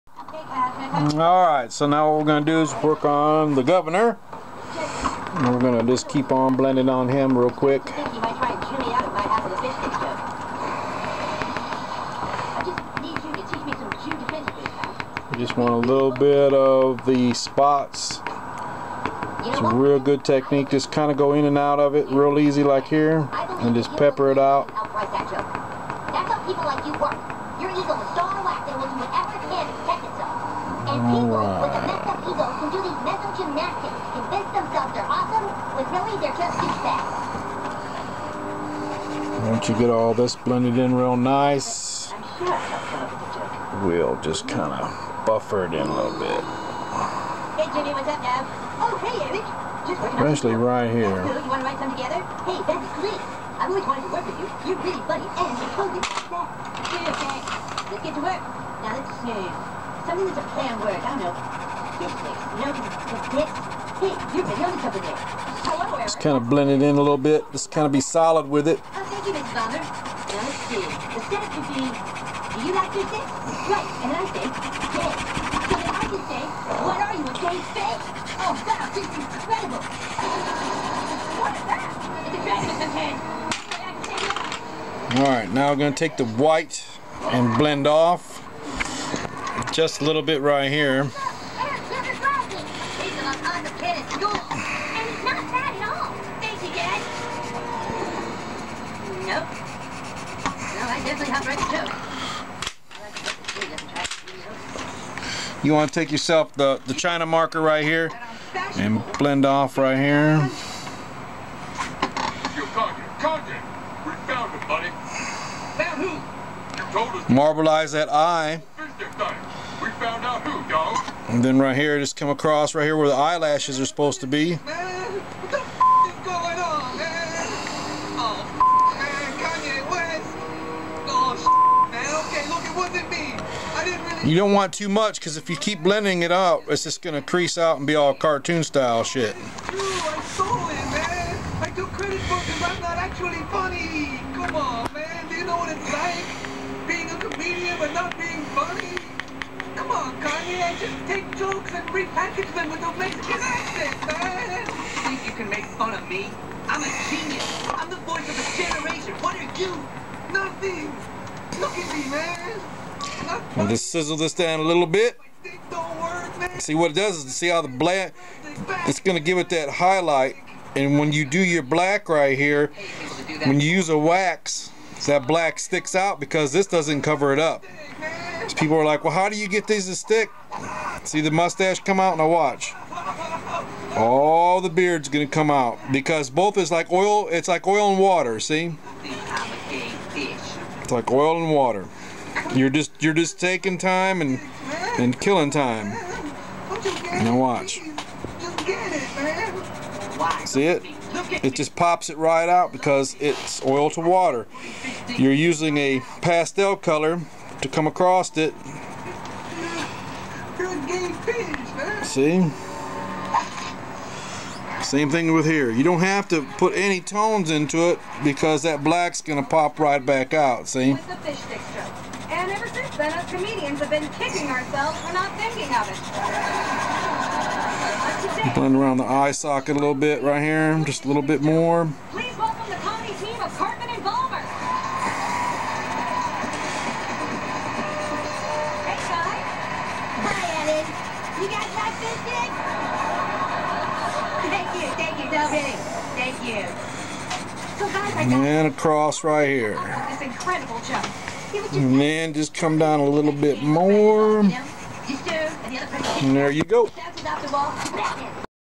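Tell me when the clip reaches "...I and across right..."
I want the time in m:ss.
4:08.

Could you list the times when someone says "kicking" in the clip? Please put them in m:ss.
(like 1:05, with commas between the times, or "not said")
3:44.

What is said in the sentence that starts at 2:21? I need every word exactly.
I took credit for I'm not actually funny.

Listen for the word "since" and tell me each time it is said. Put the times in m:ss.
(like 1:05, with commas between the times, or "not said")
3:42.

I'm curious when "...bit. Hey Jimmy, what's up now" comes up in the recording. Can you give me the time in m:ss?
0:46.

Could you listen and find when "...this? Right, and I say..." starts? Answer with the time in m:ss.
1:12.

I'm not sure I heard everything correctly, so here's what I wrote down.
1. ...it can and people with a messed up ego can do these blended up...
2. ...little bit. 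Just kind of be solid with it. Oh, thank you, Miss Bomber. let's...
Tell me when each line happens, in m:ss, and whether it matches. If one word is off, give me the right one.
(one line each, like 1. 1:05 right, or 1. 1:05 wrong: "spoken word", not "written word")
1. 0:29 wrong: "messed", not "blended"
2. 1:07 right.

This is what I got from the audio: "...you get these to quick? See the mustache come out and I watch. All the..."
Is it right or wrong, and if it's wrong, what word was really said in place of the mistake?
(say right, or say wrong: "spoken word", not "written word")
wrong: "stick", not "quick".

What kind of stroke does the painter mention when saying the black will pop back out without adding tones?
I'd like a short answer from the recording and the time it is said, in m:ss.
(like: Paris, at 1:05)
Fish stick stroke, at 3:41.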